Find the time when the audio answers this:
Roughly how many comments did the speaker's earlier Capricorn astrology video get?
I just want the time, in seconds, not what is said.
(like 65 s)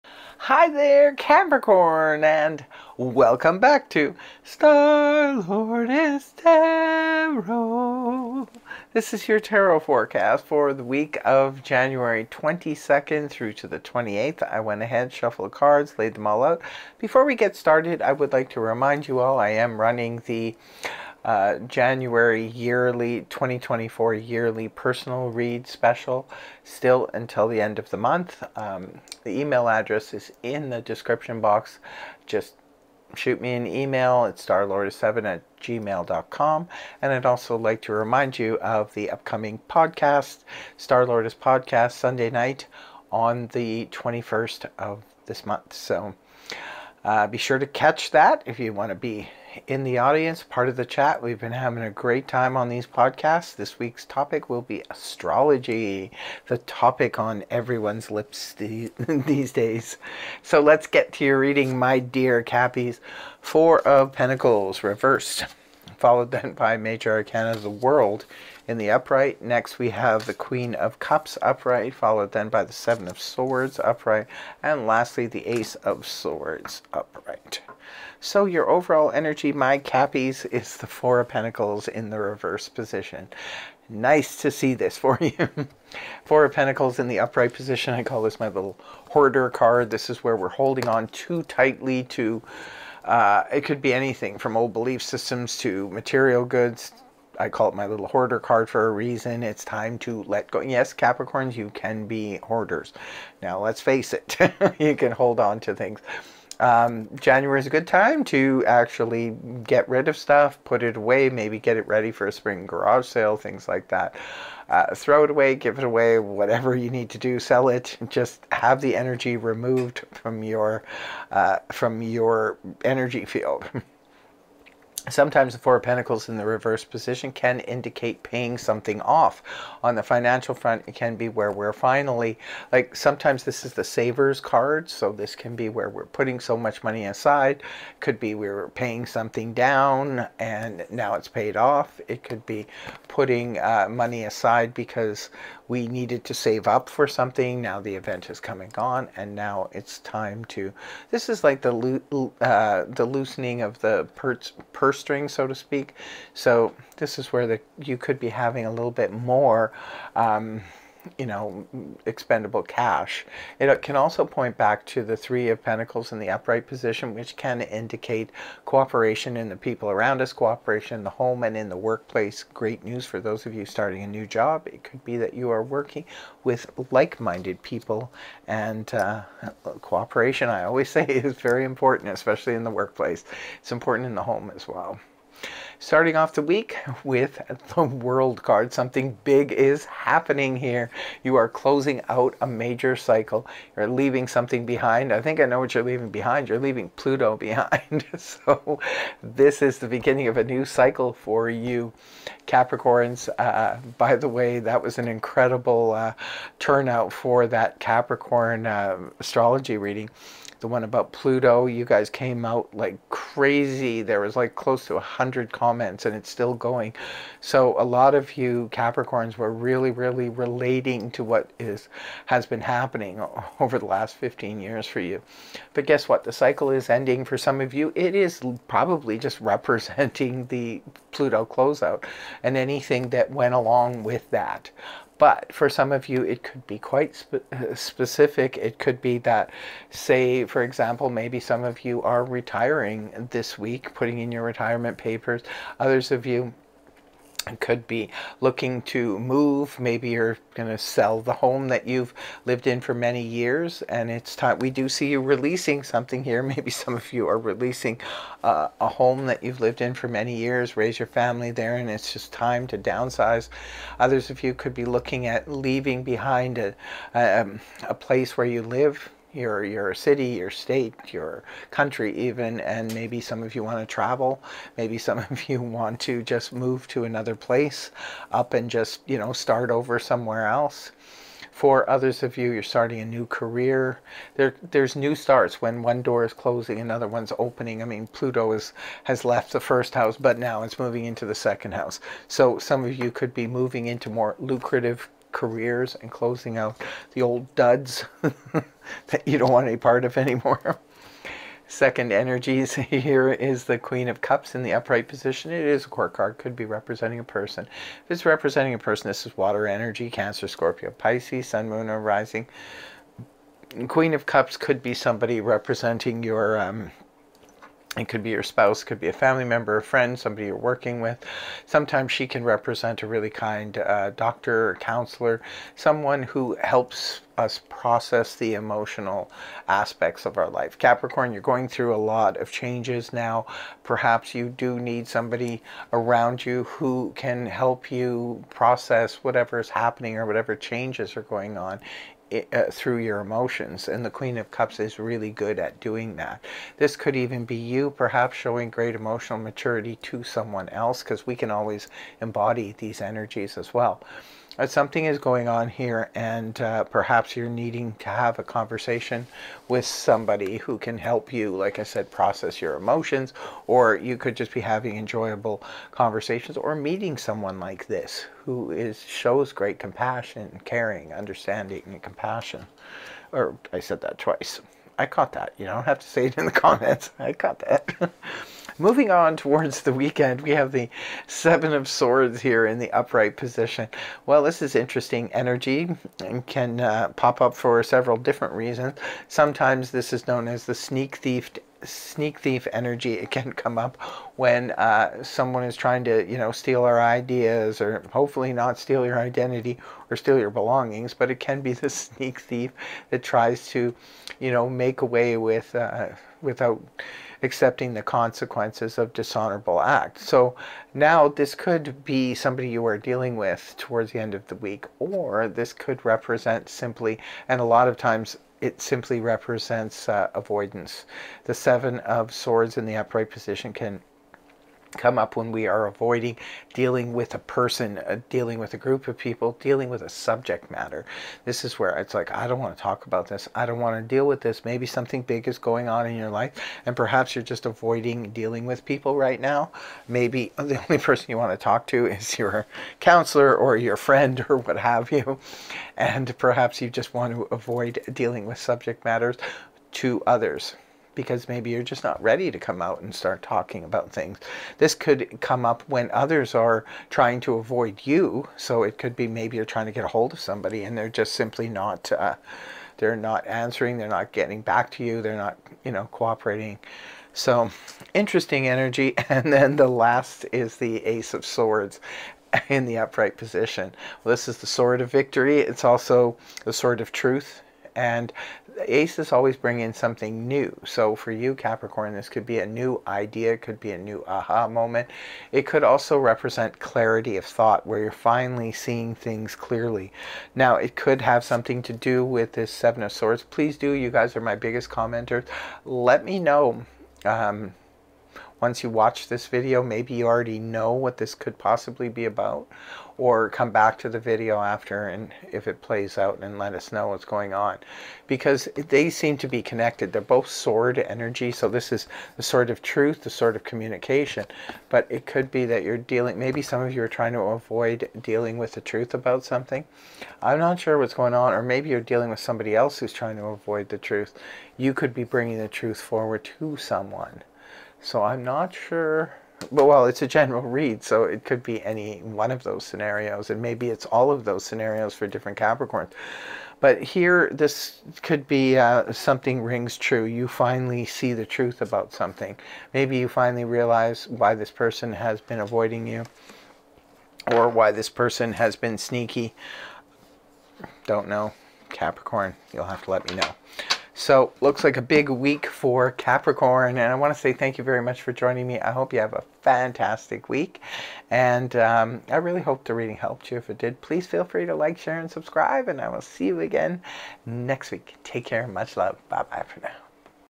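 214 s.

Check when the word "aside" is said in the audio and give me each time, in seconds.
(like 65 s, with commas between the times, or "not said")
137 s, 144 s.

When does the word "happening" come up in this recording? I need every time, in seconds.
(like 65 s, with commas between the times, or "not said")
189 s, 222 s, 339 s.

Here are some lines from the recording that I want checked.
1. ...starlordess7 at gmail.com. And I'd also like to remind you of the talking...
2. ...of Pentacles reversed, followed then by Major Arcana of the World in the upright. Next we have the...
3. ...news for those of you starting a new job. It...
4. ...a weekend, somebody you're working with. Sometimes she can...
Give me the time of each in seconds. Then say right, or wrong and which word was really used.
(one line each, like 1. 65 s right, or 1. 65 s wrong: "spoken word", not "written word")
1. 34 s wrong: "upcoming", not "talking"
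2. 63 s right
3. 172 s right
4. 319 s wrong: "friend", not "weekend".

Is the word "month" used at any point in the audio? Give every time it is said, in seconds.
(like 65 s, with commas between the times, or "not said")
27 s, 45 s.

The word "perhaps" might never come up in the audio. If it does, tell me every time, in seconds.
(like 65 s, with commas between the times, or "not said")
333 s, 347 s, 356 s, 436 s, 446 s.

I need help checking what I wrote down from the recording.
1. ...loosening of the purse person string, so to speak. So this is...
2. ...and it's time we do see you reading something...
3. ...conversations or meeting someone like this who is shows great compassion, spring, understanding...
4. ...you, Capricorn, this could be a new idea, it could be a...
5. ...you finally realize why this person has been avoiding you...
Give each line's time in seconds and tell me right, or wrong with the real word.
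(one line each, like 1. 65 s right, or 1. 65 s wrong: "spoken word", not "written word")
1. 153 s right
2. 253 s wrong: "releasing", not "reading"
3. 365 s wrong: "caring", not "spring"
4. 481 s right
5. 543 s right.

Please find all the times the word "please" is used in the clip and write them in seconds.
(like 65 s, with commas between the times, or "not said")
493 s, 564 s.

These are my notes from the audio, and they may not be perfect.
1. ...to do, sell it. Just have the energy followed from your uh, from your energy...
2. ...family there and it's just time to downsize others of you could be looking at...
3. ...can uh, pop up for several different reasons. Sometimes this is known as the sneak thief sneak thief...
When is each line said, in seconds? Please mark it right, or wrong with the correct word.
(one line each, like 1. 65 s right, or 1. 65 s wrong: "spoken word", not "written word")
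1. 117 s wrong: "removed", not "followed"
2. 261 s right
3. 386 s right.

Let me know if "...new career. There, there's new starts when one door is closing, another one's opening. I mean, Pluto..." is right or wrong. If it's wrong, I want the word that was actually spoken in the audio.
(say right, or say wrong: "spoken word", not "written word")
right.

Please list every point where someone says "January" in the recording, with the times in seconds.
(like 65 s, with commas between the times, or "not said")
11 s, 21 s, 107 s.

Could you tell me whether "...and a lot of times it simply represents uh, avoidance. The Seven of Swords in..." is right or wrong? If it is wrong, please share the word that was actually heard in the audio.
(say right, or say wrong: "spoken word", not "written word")
right.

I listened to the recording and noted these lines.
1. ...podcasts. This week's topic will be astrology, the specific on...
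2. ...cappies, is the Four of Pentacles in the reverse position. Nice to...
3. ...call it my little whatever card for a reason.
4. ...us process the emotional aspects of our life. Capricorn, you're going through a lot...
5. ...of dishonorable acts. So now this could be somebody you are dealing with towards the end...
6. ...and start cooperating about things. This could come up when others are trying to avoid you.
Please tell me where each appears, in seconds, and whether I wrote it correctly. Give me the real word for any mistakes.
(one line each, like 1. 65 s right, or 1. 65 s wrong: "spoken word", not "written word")
1. 52 s wrong: "topic", not "specific"
2. 79 s right
3. 97 s wrong: "hoarder", not "whatever"
4. 327 s right
5. 408 s right
6. 453 s wrong: "talking", not "cooperating".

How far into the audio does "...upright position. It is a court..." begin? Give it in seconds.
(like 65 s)
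304 s.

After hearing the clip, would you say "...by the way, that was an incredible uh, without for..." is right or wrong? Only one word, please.
wrong.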